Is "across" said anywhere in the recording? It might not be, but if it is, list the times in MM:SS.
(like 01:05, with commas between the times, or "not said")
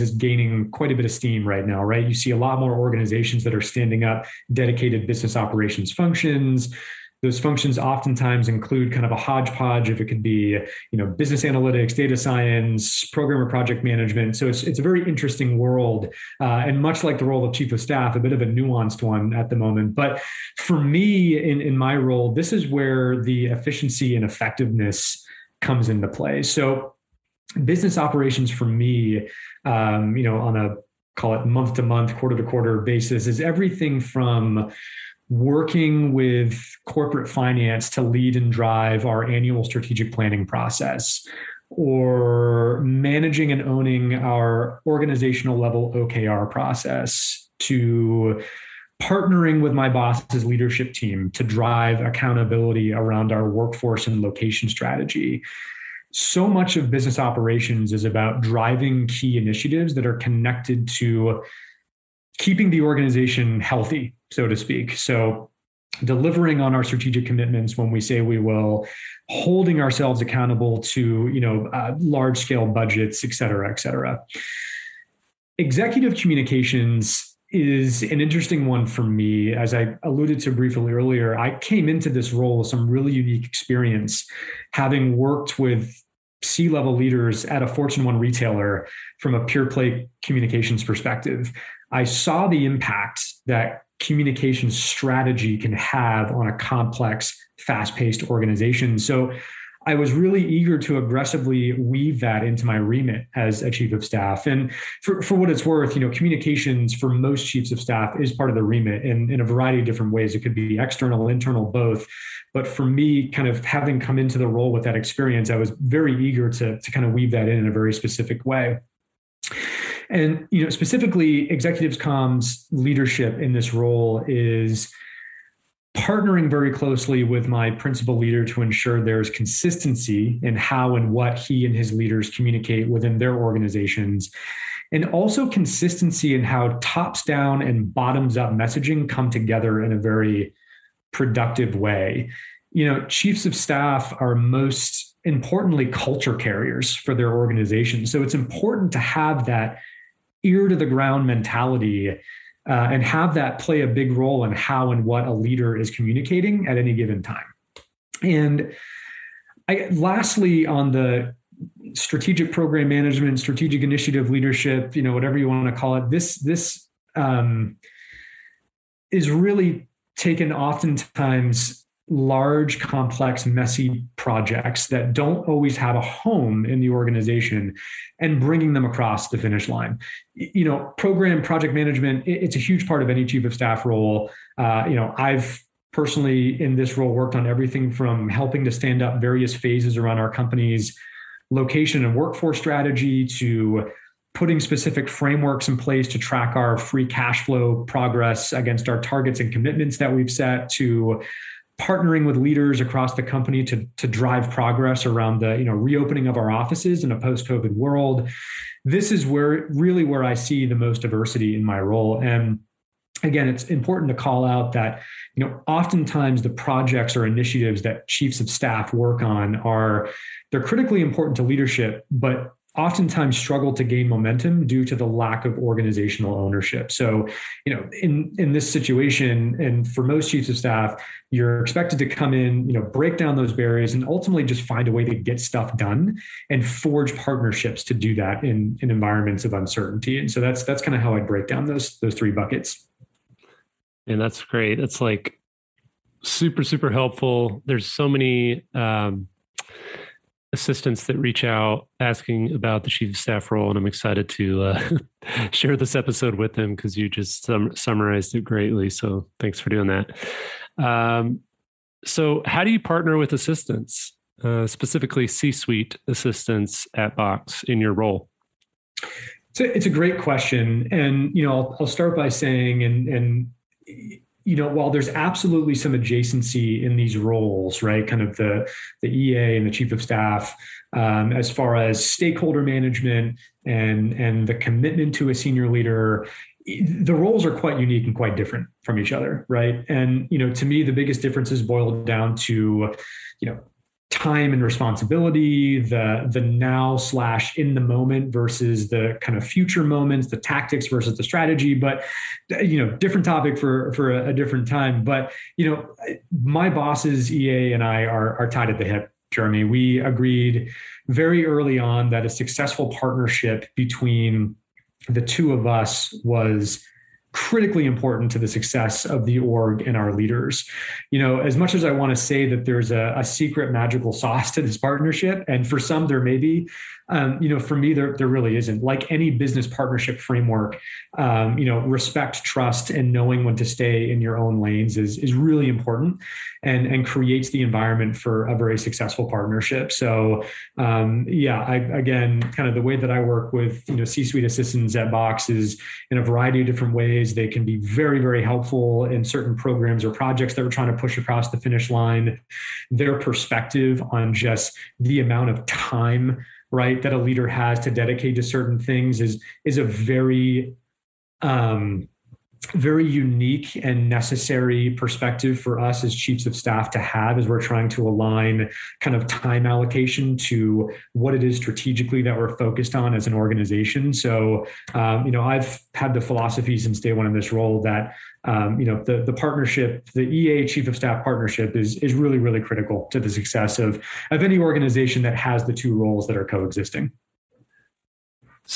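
02:58, 03:22, 05:51.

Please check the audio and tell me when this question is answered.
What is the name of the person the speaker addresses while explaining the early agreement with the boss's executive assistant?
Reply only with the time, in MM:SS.
05:09.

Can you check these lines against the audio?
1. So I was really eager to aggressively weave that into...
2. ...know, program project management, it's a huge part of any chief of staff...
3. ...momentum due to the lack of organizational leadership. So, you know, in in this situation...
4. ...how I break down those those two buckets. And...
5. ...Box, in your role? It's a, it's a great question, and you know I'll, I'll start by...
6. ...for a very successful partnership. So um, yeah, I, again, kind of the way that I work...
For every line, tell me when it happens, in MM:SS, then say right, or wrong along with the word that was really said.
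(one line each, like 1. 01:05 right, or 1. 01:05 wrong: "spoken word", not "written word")
1. 01:38 right
2. 03:00 right
3. 03:44 wrong: "ownership", not "leadership"
4. 04:01 wrong: "three", not "two"
5. 04:27 right
6. 05:38 right.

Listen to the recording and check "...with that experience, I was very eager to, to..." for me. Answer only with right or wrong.
right.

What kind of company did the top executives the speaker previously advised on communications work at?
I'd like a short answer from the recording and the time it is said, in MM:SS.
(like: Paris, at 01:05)
Fortune 1 retailer, at 01:27.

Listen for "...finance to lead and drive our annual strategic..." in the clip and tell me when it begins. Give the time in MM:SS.
00:37.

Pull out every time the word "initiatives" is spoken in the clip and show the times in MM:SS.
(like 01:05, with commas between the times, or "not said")
00:59, 02:43, 03:37.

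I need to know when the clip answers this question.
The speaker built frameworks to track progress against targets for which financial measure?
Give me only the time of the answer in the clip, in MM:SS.
03:16.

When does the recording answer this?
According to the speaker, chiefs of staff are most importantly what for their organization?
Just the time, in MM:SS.
02:25.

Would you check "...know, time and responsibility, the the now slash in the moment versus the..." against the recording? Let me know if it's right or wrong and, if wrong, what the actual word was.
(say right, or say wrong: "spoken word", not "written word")
right.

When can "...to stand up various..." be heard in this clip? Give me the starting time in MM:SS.
03:08.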